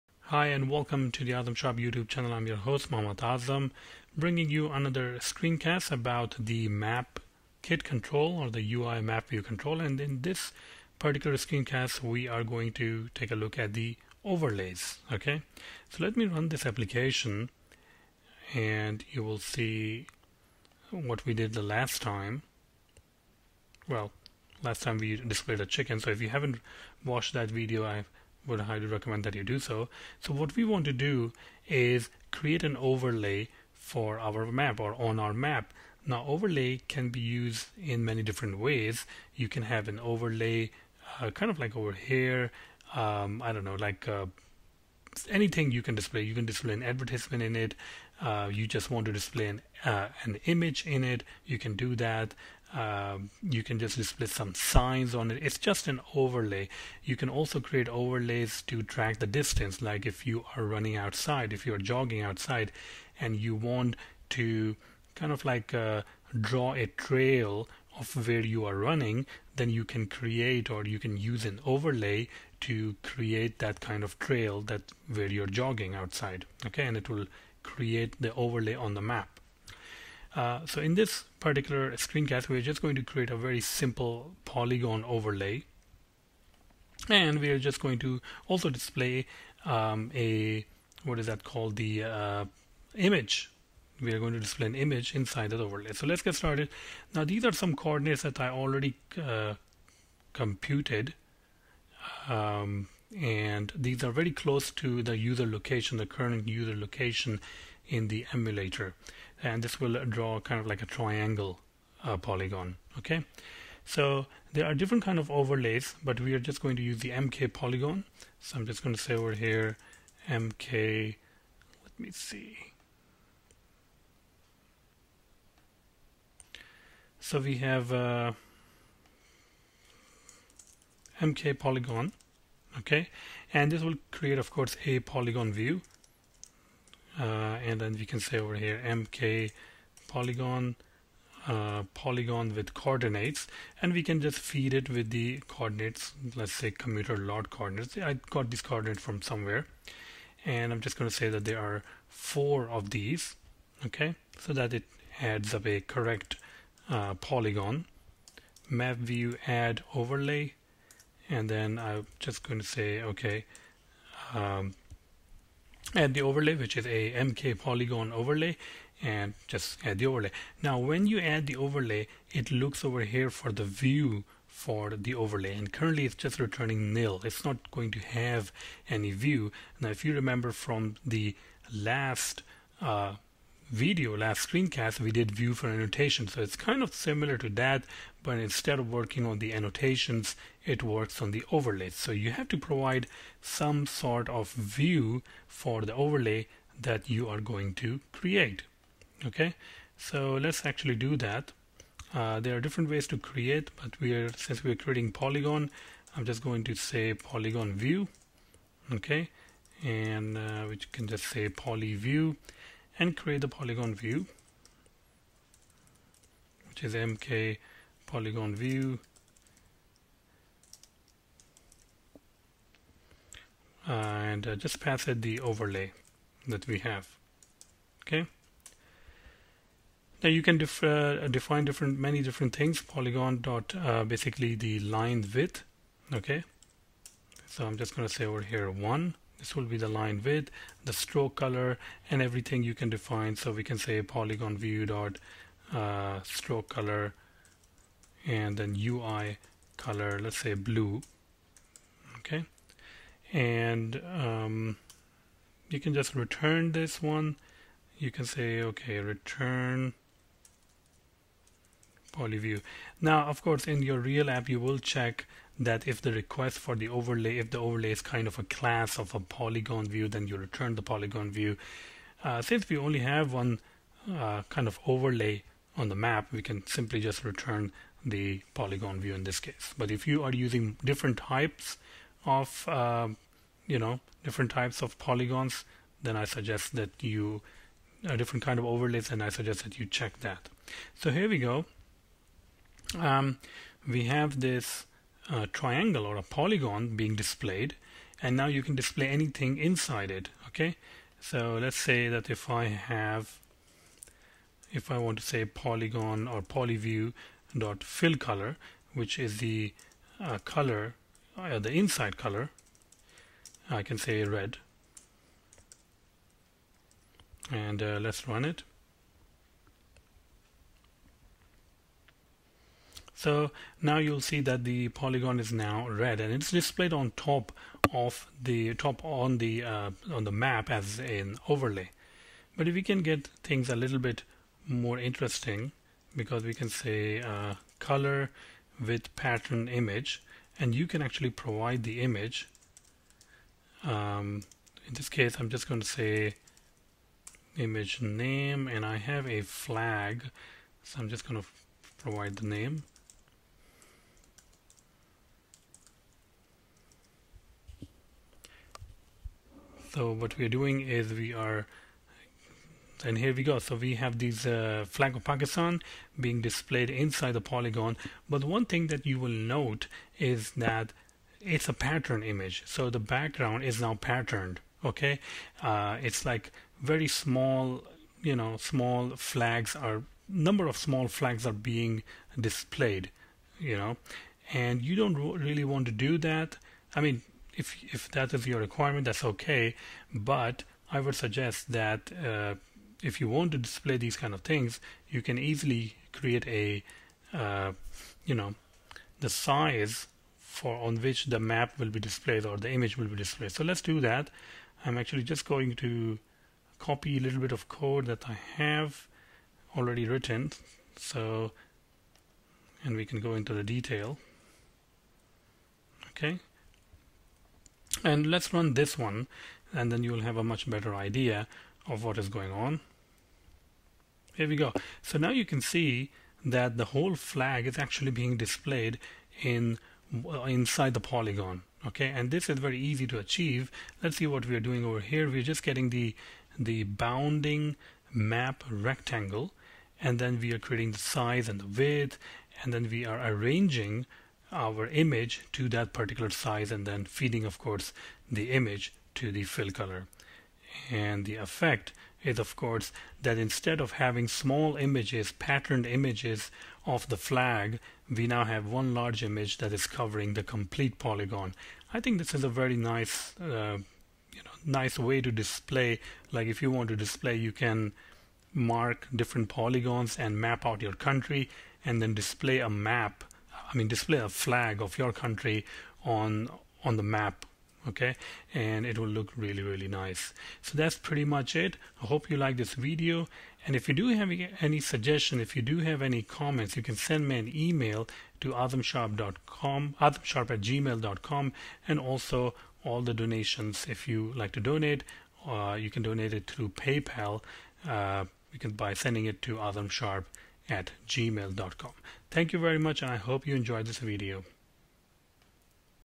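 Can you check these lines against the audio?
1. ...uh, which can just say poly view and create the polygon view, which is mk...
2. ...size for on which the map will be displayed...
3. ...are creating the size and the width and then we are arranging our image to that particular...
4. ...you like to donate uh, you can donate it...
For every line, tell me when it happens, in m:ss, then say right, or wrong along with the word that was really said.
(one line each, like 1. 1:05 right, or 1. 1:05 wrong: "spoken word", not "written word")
1. 3:30 right
2. 6:39 right
3. 7:20 right
4. 8:14 right.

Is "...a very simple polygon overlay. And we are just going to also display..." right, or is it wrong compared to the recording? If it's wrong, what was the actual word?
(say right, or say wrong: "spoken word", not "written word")
right.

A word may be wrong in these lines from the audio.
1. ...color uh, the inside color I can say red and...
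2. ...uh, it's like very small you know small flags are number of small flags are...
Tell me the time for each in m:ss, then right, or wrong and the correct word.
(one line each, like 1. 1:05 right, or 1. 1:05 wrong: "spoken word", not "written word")
1. 5:10 right
2. 6:15 right.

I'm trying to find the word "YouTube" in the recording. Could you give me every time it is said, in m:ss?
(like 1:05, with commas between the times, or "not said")
0:01.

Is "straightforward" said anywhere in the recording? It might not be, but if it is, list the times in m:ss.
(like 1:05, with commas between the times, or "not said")
not said.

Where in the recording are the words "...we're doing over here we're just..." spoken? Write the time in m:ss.
7:14.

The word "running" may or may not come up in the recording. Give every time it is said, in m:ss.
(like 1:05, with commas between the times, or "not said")
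1:00, 1:08.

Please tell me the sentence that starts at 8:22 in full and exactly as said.
Thank you very much and I hope you enjoyed this video.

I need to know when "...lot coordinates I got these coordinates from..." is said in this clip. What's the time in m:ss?
2:27.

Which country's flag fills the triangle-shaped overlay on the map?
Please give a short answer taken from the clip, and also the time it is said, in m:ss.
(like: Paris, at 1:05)
Pakistan, at 6:05.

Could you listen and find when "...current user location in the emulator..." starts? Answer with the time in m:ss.
1:46.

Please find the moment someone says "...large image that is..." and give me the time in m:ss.
7:38.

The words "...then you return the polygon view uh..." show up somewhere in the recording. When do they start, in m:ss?
4:30.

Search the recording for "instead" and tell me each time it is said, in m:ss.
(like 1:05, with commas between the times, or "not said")
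3:08, 7:33.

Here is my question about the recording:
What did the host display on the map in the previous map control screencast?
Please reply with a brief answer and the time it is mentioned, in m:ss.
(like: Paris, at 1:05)
A chicken, at 0:25.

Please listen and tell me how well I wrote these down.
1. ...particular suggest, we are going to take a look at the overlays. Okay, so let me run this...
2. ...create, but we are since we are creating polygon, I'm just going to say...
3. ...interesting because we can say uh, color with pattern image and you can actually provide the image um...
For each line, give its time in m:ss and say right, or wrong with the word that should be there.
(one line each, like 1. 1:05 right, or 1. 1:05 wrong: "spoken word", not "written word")
1. 0:10 wrong: "screencast", not "suggest"
2. 3:23 right
3. 5:34 right.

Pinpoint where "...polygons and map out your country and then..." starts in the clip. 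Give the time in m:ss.
7:49.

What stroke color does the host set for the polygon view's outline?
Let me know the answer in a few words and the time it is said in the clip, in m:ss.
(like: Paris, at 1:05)
Blue, at 4:10.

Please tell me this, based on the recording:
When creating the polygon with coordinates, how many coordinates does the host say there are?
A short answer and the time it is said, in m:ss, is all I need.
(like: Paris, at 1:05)
4, at 2:32.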